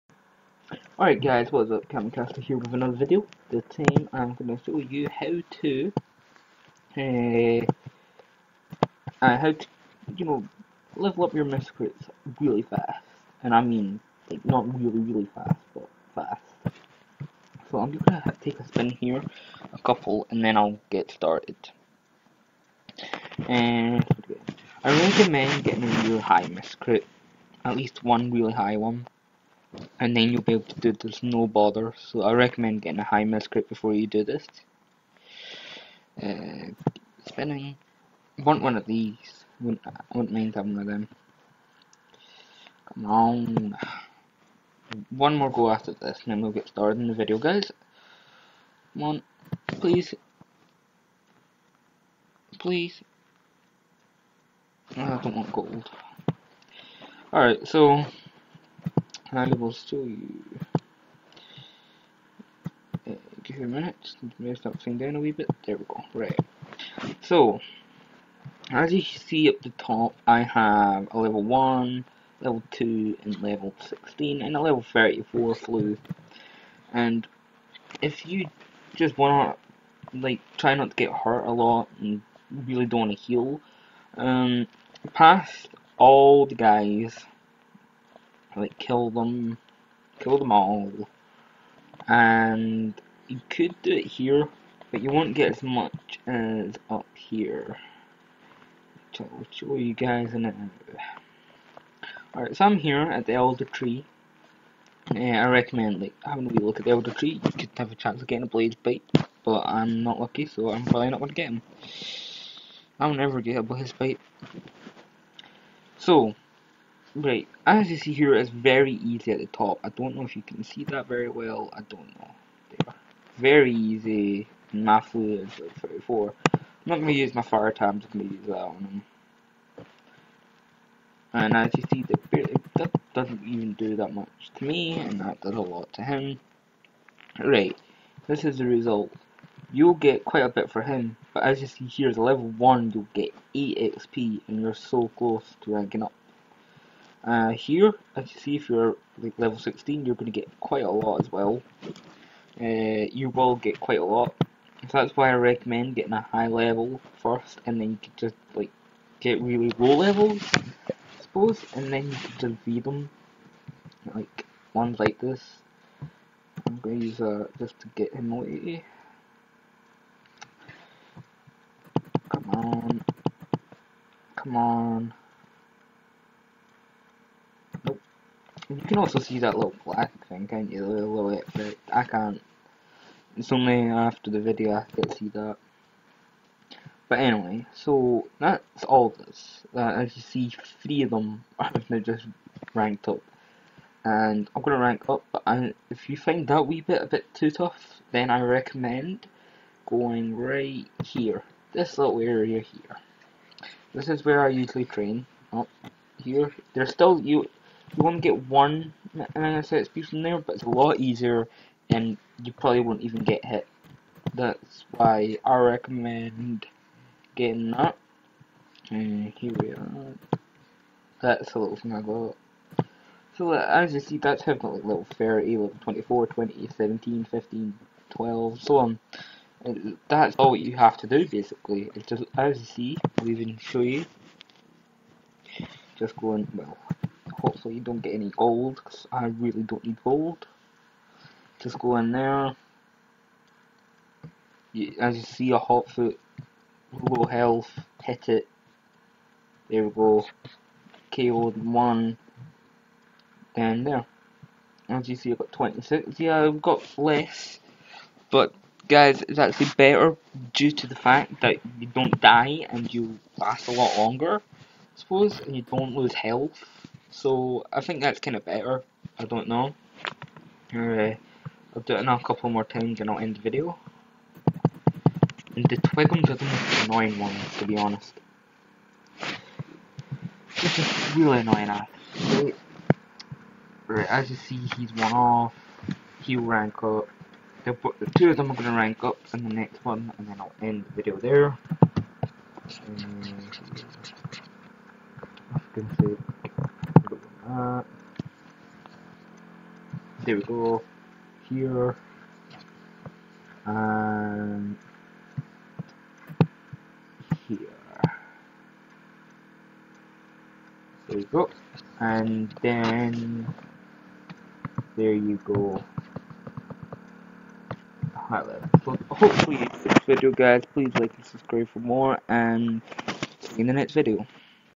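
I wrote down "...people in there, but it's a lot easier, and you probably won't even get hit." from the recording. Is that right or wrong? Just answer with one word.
right.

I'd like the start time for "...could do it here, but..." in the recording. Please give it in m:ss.
1:33.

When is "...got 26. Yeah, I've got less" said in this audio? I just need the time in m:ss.
4:15.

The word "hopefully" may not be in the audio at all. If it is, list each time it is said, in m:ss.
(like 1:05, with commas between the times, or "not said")
3:57, 5:19.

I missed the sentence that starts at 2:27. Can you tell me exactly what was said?
Uh, here, as you see, if you're like level 16, you're going to get quite a lot as well.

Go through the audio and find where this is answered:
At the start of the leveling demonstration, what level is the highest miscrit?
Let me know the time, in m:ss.
1:14.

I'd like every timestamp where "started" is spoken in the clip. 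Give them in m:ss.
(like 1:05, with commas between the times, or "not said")
0:21, 0:46.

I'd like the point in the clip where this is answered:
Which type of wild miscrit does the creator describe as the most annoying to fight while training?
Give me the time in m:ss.
4:35.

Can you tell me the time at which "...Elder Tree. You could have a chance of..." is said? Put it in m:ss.
1:46.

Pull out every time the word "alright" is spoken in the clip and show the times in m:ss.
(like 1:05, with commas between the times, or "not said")
0:01, 0:57, 1:42.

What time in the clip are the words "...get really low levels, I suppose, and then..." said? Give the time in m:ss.
2:39.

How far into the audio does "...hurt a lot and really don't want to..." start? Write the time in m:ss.
1:21.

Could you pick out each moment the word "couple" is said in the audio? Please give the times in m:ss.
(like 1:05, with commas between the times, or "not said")
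0:19, 4:32.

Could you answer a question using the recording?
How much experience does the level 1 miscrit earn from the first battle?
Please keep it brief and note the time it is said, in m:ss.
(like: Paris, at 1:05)
8 XP, at 2:23.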